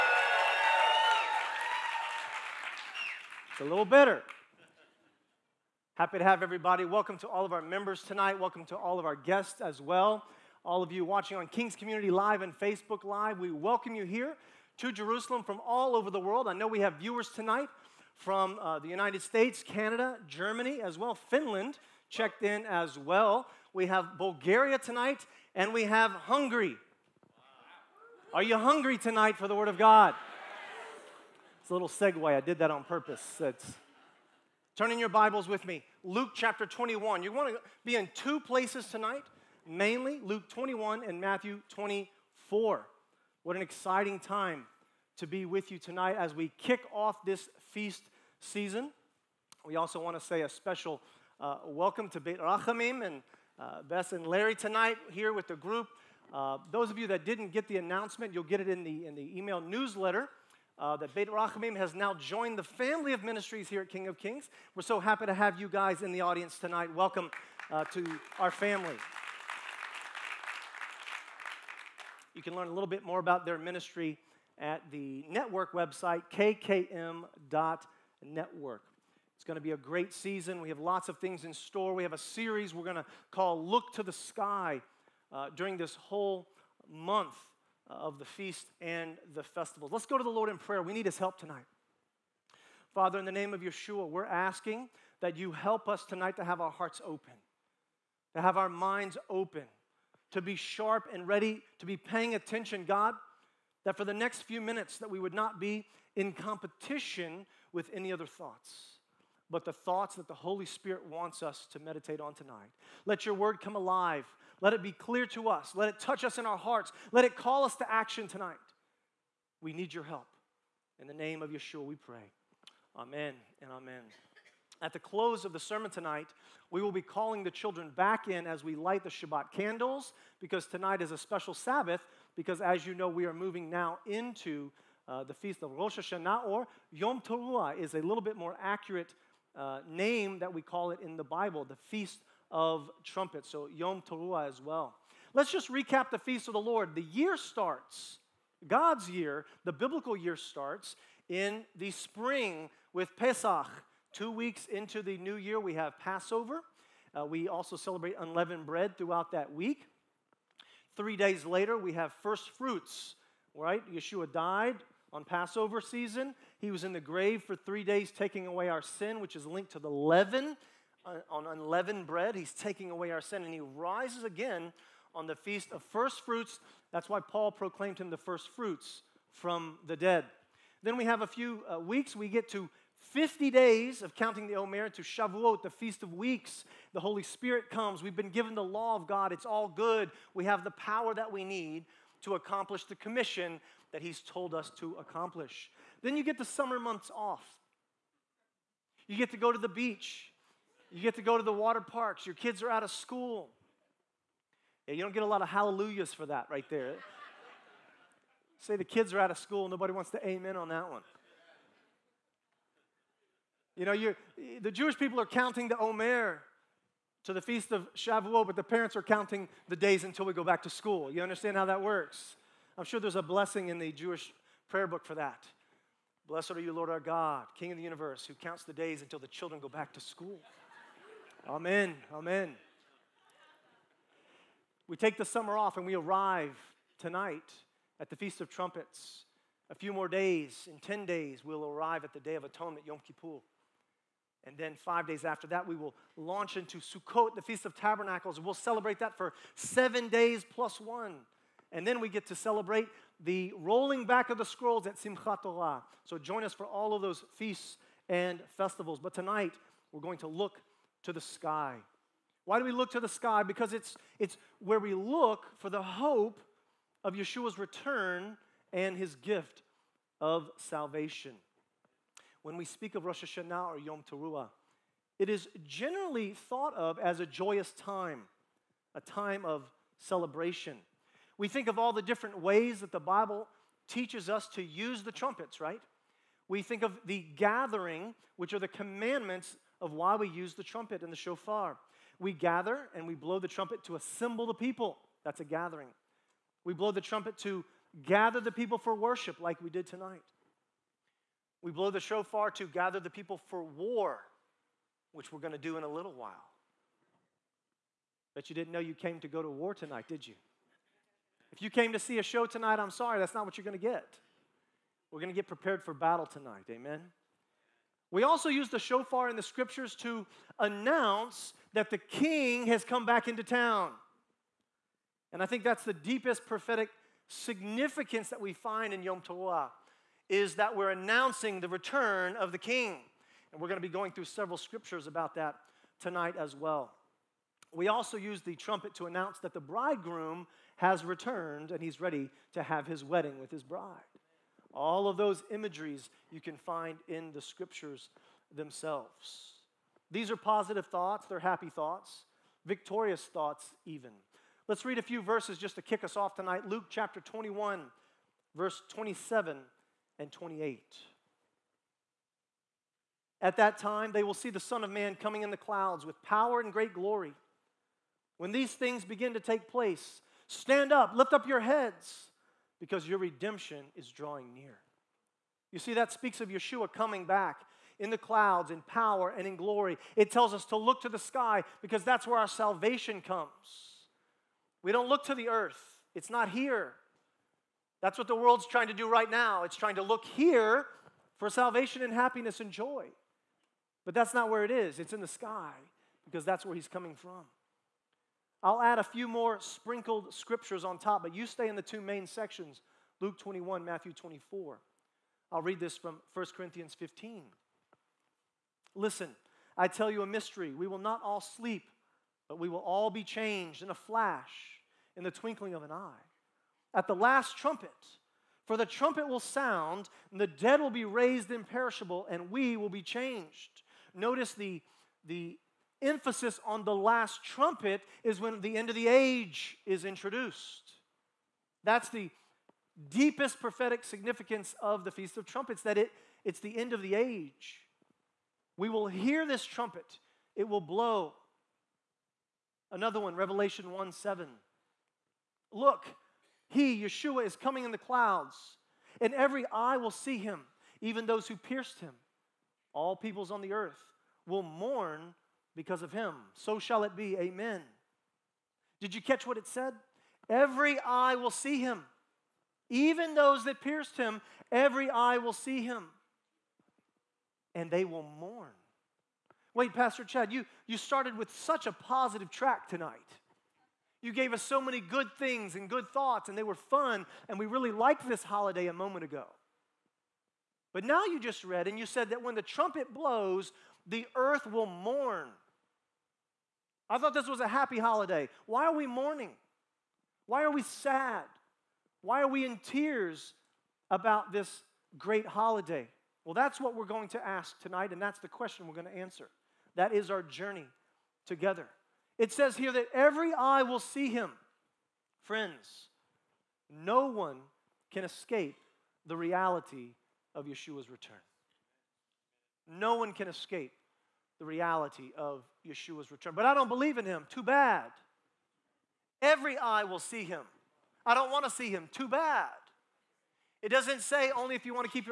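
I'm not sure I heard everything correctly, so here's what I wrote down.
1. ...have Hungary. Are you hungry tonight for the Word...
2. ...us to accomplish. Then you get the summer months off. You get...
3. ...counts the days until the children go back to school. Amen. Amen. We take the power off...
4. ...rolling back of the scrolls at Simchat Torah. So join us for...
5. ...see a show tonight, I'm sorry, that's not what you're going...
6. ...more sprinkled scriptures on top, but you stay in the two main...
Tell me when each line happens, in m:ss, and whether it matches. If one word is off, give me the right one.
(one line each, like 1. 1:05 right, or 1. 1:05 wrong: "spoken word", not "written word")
1. 0:25 right
2. 3:14 right
3. 3:48 wrong: "summer", not "power"
4. 4:13 right
5. 5:11 right
6. 6:39 right.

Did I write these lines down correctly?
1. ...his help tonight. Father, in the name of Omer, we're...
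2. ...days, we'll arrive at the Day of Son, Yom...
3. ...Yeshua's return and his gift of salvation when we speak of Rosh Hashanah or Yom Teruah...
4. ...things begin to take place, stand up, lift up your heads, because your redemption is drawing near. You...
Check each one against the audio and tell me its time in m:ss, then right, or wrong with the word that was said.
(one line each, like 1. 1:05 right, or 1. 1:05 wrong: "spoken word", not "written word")
1. 1:31 wrong: "Yeshua", not "Omer"
2. 4:01 wrong: "Atonement", not "Son"
3. 4:27 right
4. 6:08 right.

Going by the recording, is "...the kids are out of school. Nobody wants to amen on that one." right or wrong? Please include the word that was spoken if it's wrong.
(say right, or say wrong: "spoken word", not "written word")
right.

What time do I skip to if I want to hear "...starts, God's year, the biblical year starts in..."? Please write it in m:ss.
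2:27.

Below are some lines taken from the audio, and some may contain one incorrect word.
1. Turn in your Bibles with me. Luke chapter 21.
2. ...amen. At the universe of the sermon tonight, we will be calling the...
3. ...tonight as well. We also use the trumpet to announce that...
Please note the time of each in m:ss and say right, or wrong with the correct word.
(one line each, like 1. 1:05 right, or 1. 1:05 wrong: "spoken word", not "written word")
1. 0:34 right
2. 2:03 wrong: "close", not "universe"
3. 5:36 right.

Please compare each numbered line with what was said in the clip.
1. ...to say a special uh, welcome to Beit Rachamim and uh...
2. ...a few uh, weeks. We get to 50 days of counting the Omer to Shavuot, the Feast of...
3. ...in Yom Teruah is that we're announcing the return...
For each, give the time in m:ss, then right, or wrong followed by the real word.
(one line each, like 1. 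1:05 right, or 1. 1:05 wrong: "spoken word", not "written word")
1. 0:50 right
2. 3:01 right
3. 5:28 right.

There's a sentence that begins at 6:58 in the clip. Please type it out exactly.
For the trumpet will sound, and the dead will be raised imperishable, and we will be changed.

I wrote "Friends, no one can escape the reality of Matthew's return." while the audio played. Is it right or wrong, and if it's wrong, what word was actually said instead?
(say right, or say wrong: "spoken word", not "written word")
wrong: "Yeshua", not "Matthew".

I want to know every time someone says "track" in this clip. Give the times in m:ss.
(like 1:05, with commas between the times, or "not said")
7:52.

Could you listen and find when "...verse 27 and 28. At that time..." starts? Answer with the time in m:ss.
5:58.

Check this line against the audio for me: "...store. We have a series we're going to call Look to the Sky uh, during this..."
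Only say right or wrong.
right.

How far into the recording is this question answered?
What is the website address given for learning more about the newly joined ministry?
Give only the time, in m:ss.
1:16.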